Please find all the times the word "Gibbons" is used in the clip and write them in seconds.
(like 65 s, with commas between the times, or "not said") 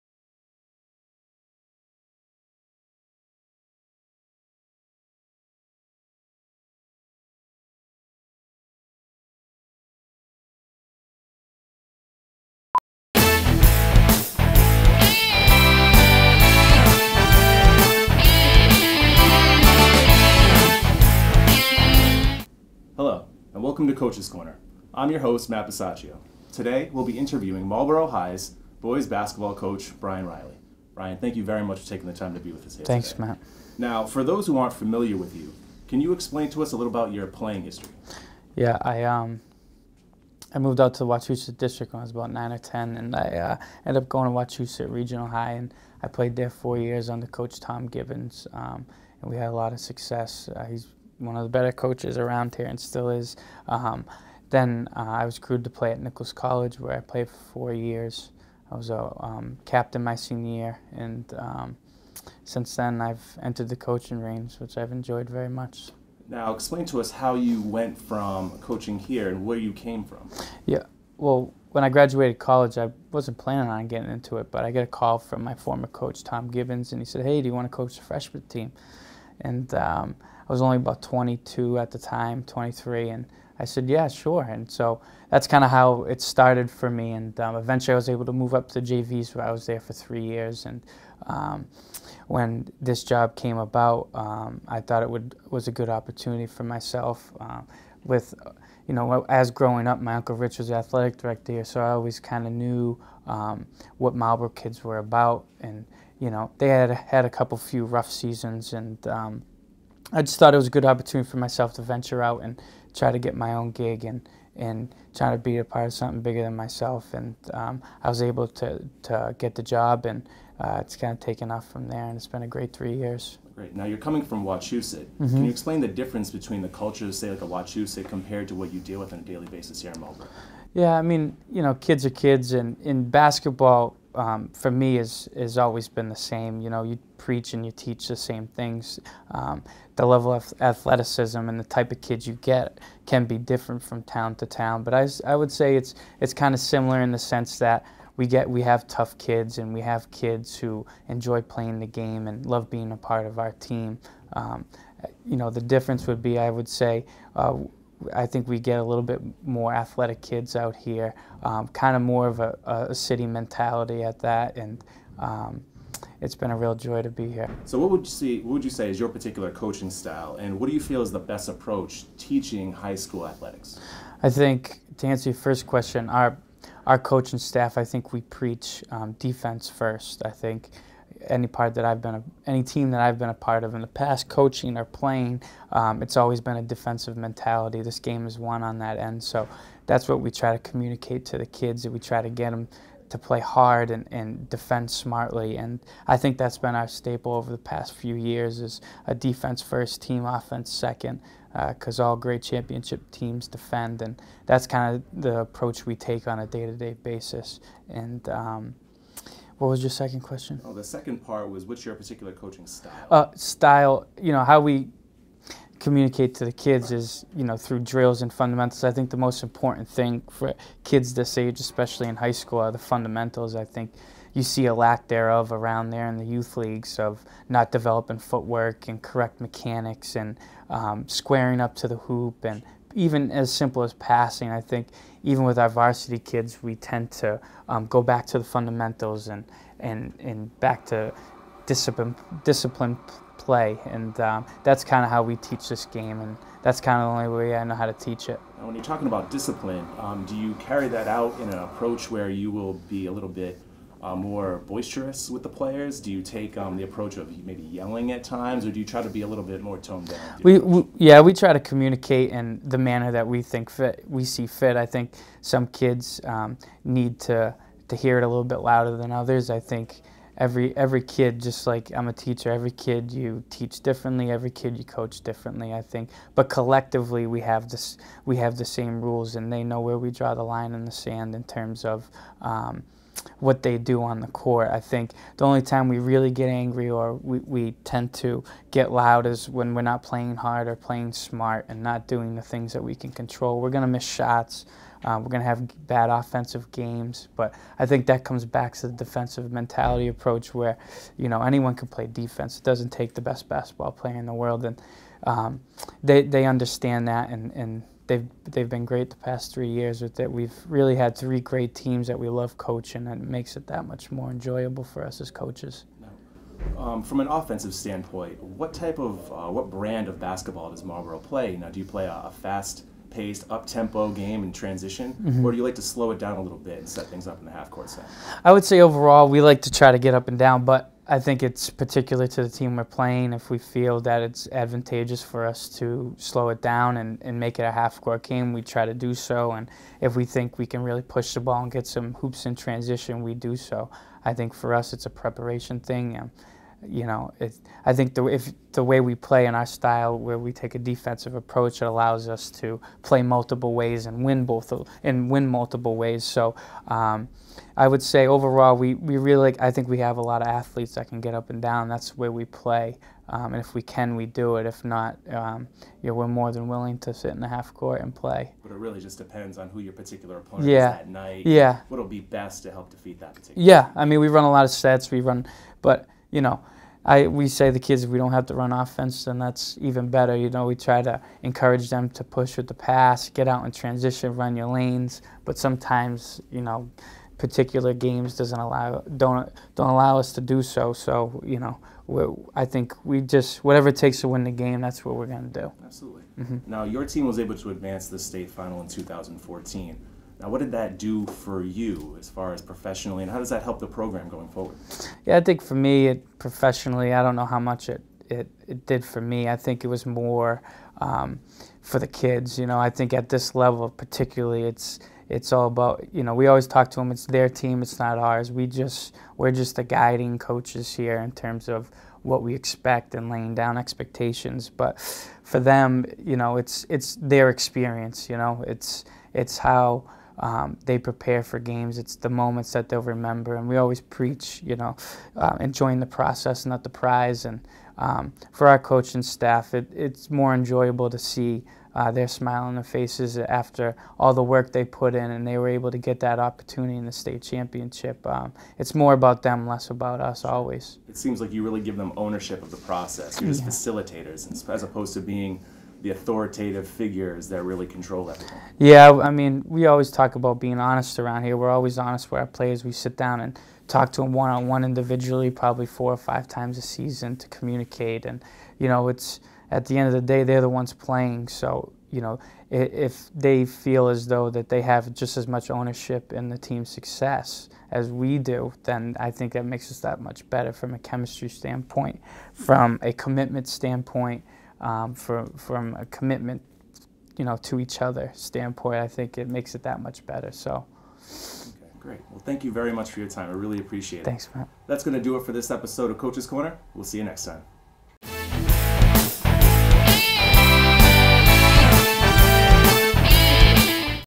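47 s, 76 s.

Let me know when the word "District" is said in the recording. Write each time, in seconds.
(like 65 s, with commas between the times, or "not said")
41 s.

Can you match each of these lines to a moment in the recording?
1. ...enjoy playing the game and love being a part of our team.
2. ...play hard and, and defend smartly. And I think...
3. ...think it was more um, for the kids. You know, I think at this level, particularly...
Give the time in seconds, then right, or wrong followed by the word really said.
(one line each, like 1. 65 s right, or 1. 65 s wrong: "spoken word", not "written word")
1. 151 s right
2. 193 s right
3. 409 s right.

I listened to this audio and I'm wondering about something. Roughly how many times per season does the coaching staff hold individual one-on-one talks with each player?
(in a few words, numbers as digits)
4 or 5.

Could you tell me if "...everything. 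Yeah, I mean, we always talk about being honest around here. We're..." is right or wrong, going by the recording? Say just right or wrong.
right.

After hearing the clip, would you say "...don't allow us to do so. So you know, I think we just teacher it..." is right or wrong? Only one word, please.
wrong.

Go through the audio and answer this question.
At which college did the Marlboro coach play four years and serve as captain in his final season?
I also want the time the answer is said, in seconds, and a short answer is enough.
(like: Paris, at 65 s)
Nichols College, at 56 s.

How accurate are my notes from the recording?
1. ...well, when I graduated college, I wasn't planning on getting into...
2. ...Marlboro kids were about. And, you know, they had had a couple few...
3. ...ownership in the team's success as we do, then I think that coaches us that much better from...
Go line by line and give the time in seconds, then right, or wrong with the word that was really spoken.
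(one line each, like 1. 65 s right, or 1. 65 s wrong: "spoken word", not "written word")
1. 71 s right
2. 104 s right
3. 475 s wrong: "makes", not "coaches".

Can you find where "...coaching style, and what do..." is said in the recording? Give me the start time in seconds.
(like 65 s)
169 s.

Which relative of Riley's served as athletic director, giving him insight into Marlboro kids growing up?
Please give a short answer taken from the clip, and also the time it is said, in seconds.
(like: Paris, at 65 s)
Uncle Rich, at 100 s.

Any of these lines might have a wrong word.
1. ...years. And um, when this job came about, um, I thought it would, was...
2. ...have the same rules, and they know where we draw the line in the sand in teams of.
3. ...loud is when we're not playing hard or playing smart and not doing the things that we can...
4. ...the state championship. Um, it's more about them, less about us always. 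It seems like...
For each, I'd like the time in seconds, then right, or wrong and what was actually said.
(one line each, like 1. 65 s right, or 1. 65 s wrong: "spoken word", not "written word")
1. 90 s right
2. 278 s wrong: "terms", not "teams"
3. 288 s right
4. 447 s right.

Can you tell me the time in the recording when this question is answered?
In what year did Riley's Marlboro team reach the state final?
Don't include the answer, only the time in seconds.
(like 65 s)
398 s.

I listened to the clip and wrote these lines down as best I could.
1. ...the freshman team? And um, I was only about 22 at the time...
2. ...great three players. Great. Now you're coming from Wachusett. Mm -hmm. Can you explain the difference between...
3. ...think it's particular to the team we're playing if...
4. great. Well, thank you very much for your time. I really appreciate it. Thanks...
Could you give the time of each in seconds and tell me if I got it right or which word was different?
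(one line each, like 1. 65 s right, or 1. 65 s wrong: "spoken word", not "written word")
1. 77 s right
2. 122 s wrong: "years", not "players"
3. 331 s right
4. 491 s right.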